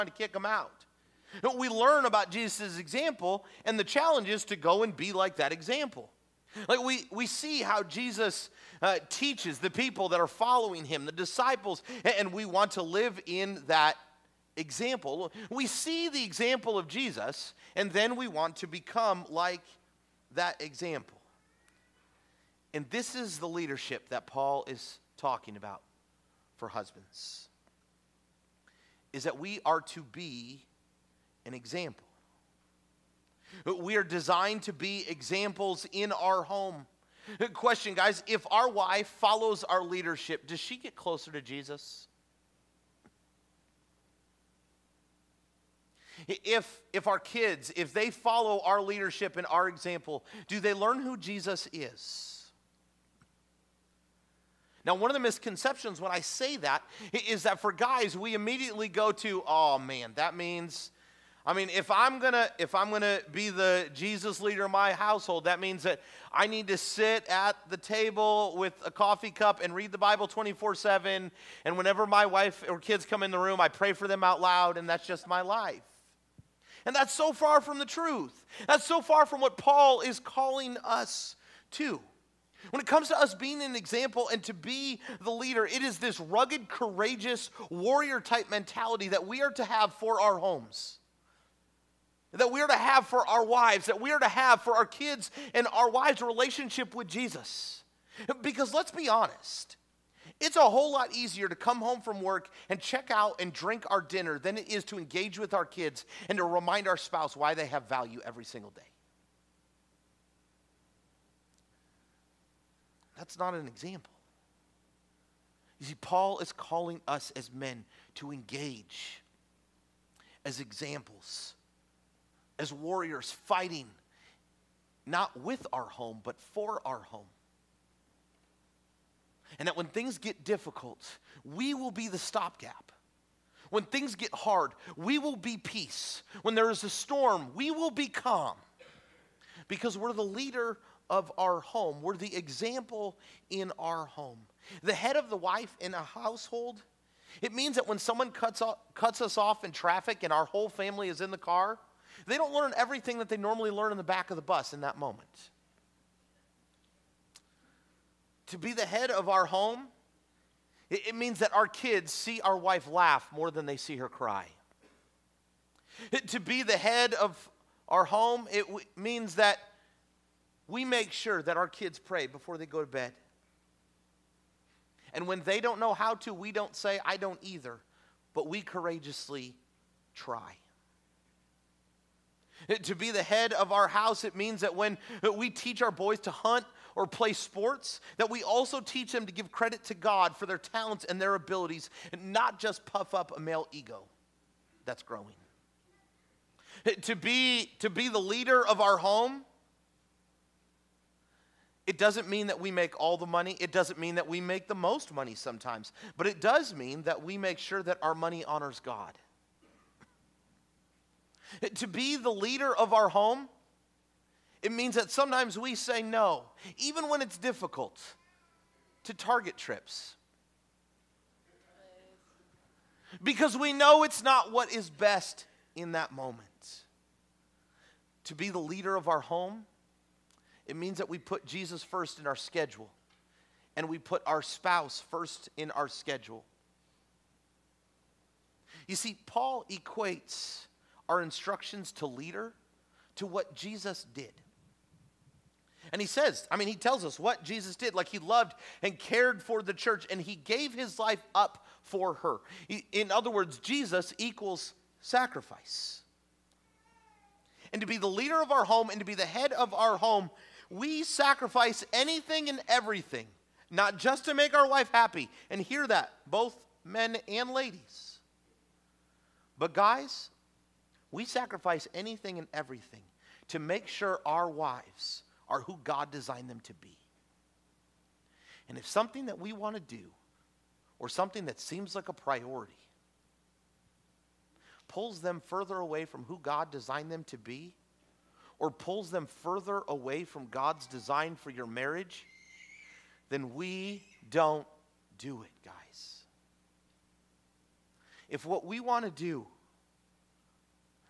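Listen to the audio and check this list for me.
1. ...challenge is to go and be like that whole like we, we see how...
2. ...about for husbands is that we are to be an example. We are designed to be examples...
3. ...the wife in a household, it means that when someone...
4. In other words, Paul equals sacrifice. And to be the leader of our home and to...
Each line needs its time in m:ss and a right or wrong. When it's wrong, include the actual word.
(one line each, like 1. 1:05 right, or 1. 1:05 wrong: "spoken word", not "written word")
1. 0:03 wrong: "example", not "whole"
2. 0:25 right
3. 2:25 right
4. 4:12 wrong: "Jesus", not "Paul".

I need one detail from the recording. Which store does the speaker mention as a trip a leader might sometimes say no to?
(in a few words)
Target.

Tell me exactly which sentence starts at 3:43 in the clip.
Because we know it's not what is best in that moment.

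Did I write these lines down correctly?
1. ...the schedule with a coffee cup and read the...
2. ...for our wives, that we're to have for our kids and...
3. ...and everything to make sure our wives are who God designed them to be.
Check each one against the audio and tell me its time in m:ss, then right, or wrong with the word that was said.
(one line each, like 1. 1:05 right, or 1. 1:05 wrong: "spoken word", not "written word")
1. 1:07 wrong: "table", not "schedule"
2. 1:33 right
3. 4:32 right.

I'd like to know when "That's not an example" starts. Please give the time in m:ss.
1:53.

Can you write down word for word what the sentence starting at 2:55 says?
And when they don't know how to, we don't say, I don't either, but we courageously try.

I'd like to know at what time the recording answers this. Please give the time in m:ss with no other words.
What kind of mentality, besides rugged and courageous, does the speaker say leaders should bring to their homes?
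1:27.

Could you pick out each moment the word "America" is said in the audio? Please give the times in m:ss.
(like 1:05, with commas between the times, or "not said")
not said.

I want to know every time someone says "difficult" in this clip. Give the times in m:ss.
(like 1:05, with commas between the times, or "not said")
2:10, 3:37.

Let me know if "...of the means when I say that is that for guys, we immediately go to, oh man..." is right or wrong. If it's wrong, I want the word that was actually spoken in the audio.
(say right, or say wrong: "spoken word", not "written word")
wrong: "misconceptions", not "means".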